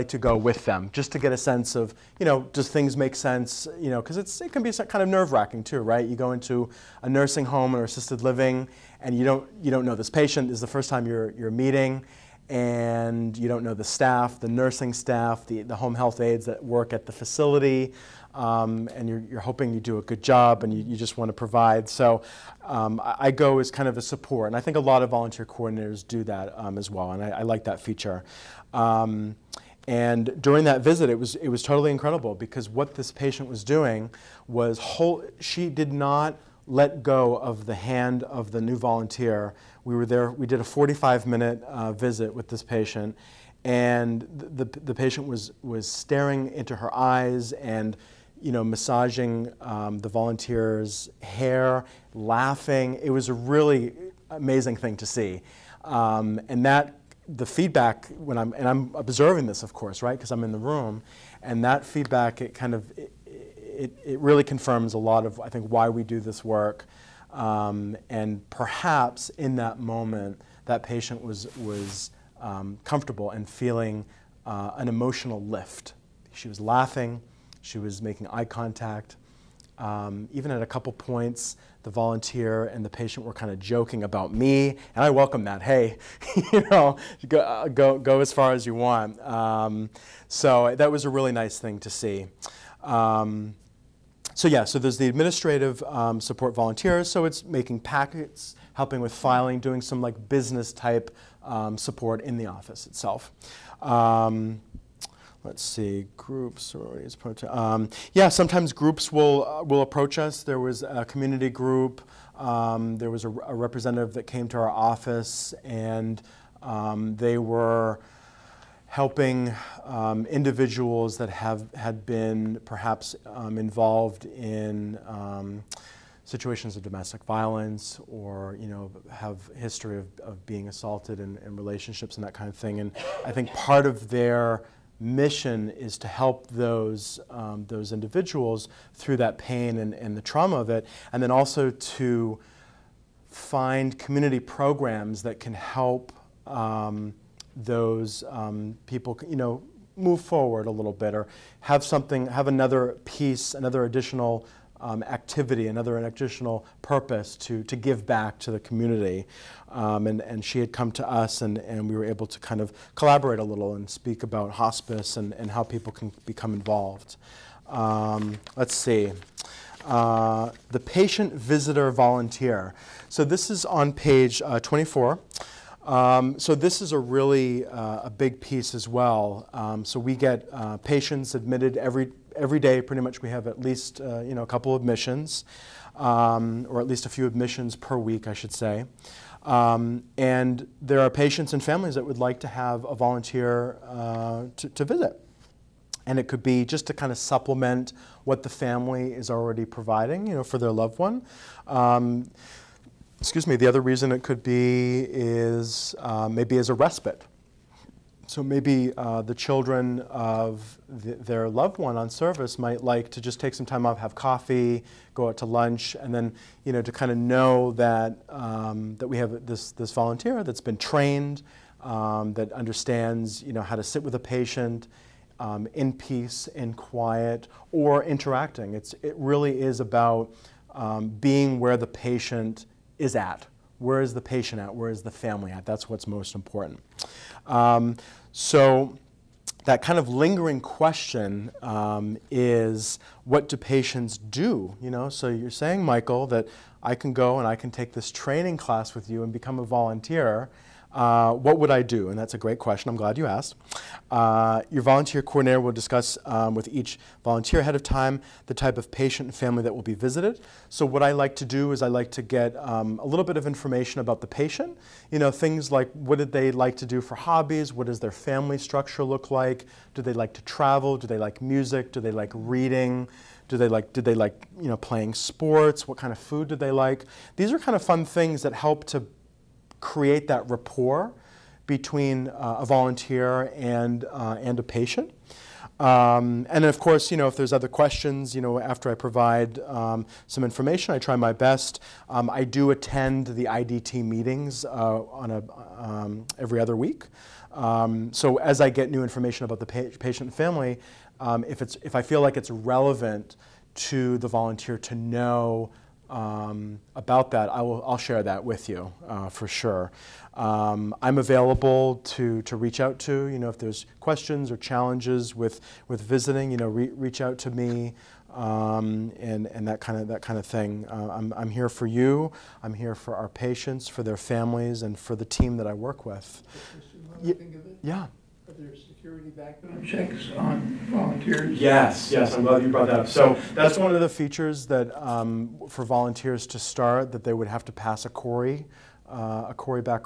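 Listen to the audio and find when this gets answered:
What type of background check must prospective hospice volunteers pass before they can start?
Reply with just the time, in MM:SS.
05:39.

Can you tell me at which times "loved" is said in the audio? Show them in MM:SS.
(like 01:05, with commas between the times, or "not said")
03:20, 03:31.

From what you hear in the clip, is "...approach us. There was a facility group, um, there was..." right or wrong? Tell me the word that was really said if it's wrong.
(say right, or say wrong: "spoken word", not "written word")
wrong: "community", not "facility".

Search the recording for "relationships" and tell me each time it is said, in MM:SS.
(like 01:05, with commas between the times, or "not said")
02:11.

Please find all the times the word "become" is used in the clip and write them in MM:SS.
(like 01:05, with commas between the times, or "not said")
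02:46, 04:09.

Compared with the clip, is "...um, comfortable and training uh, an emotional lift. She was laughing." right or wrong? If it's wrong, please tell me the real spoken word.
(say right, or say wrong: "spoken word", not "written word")
wrong: "feeling", not "training".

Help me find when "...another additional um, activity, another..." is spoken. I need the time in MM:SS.
02:33.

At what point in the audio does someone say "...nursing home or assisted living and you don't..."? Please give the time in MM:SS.
00:07.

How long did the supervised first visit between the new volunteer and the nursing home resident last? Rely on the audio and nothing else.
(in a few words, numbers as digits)
45 minutes.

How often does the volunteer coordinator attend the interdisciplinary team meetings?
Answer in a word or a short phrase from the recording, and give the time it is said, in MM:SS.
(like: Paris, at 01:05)
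every other week, at 04:56.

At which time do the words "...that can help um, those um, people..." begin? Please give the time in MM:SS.
02:25.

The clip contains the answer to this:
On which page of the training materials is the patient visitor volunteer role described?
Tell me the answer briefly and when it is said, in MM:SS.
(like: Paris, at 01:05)
24, at 02:54.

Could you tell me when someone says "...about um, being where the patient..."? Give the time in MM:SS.
03:49.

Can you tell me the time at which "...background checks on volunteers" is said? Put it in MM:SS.
05:29.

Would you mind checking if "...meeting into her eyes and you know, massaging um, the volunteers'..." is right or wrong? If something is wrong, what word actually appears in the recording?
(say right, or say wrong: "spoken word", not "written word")
wrong: "staring", not "meeting".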